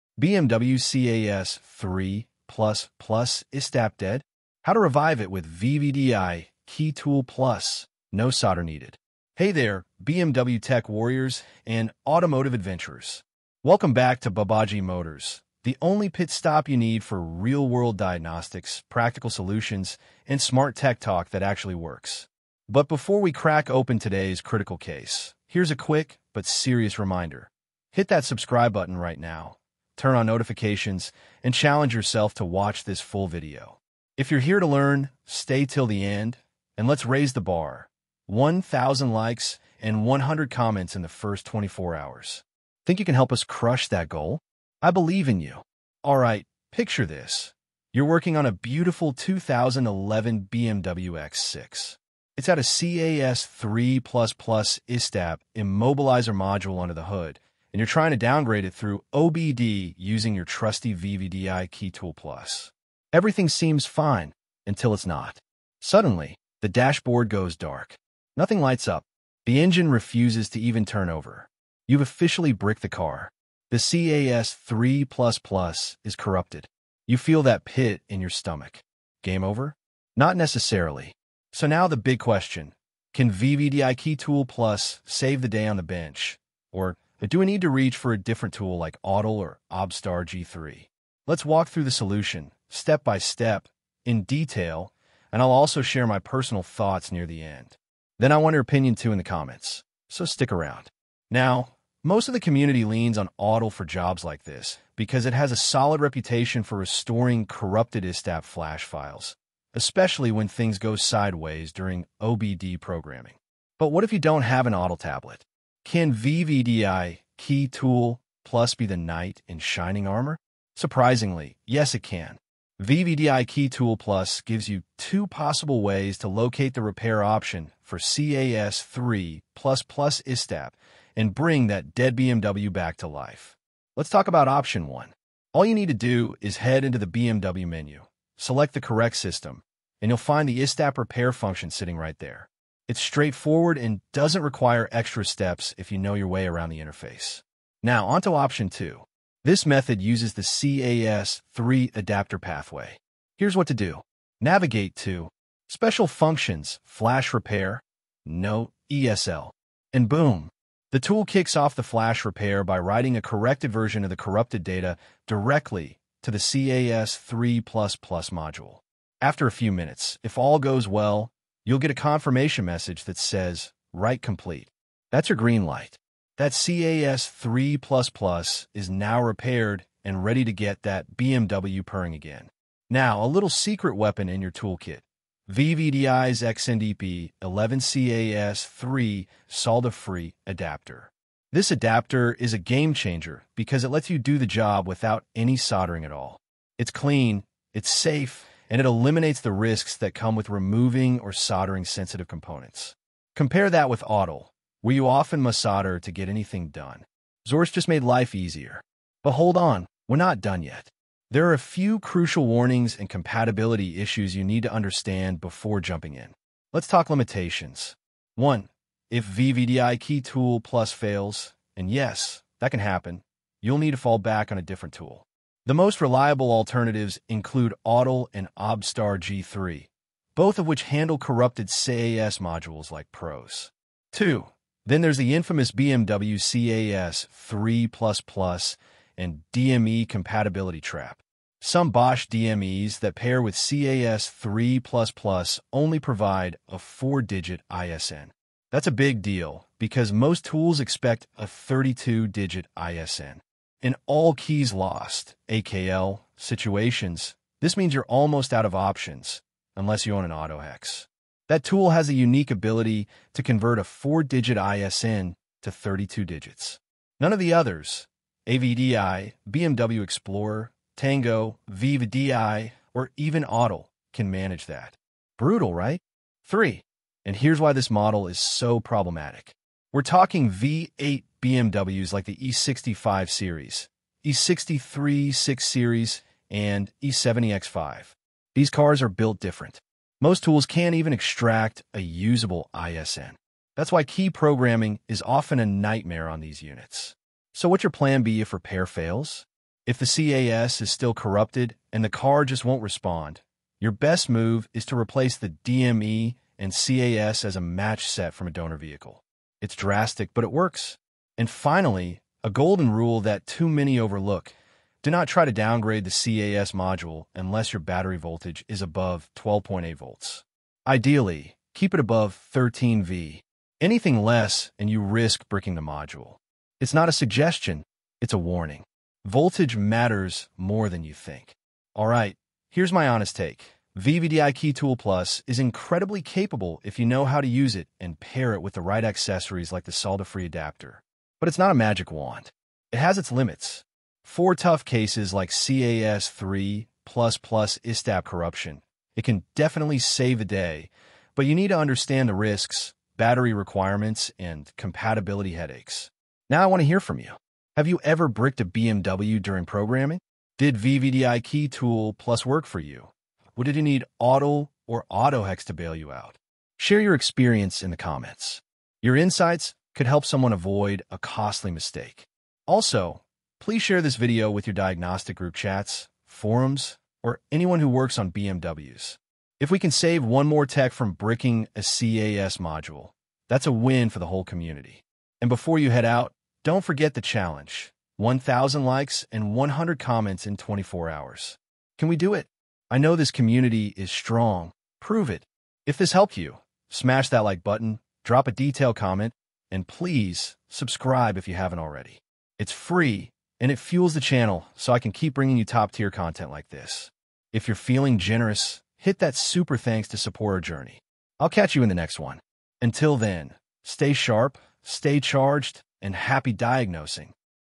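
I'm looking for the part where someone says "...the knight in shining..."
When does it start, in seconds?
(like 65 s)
118 s.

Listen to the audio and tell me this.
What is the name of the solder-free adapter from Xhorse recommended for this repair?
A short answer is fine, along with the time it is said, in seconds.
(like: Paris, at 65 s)
XNDP 11CAS3, at 186 s.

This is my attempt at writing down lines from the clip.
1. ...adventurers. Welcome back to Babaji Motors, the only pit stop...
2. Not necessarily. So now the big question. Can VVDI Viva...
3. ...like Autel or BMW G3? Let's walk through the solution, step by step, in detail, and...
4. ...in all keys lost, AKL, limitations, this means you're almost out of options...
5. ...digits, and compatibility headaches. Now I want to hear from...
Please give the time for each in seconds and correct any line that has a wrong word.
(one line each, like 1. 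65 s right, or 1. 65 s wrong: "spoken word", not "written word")
1. 12 s right
2. 80 s wrong: "Key", not "Viva"
3. 88 s wrong: "OBDSTAR", not "BMW"
4. 253 s wrong: "situations", not "limitations"
5. 353 s wrong: "requirements", not "digits".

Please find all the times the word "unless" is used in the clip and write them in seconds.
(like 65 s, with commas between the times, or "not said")
259 s, 317 s.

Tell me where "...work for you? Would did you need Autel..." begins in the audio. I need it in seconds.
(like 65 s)
362 s.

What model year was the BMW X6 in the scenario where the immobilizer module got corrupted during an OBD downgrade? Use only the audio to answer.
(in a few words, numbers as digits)
2011.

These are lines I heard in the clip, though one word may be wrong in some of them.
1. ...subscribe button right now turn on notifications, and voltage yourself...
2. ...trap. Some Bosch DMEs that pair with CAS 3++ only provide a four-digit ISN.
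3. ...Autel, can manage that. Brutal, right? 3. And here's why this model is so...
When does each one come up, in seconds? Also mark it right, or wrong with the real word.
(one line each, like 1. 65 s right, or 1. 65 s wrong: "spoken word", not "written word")
1. 28 s wrong: "challenge", not "voltage"
2. 240 s right
3. 273 s right.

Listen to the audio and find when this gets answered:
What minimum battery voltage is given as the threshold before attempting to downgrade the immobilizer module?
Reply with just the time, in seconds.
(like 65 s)
319 s.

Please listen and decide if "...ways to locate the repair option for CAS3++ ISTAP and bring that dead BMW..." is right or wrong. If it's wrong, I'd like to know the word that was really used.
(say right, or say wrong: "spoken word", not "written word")
right.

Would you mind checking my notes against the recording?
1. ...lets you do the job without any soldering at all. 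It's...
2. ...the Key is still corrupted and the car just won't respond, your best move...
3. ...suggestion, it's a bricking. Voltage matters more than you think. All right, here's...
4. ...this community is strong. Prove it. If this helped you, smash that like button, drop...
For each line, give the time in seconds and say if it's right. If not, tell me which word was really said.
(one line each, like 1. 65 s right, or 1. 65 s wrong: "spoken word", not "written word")
1. 193 s right
2. 299 s wrong: "CAS", not "Key"
3. 327 s wrong: "warning", not "bricking"
4. 393 s right.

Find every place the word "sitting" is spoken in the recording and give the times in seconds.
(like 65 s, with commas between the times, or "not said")
141 s.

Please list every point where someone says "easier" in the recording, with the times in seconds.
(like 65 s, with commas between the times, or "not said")
208 s.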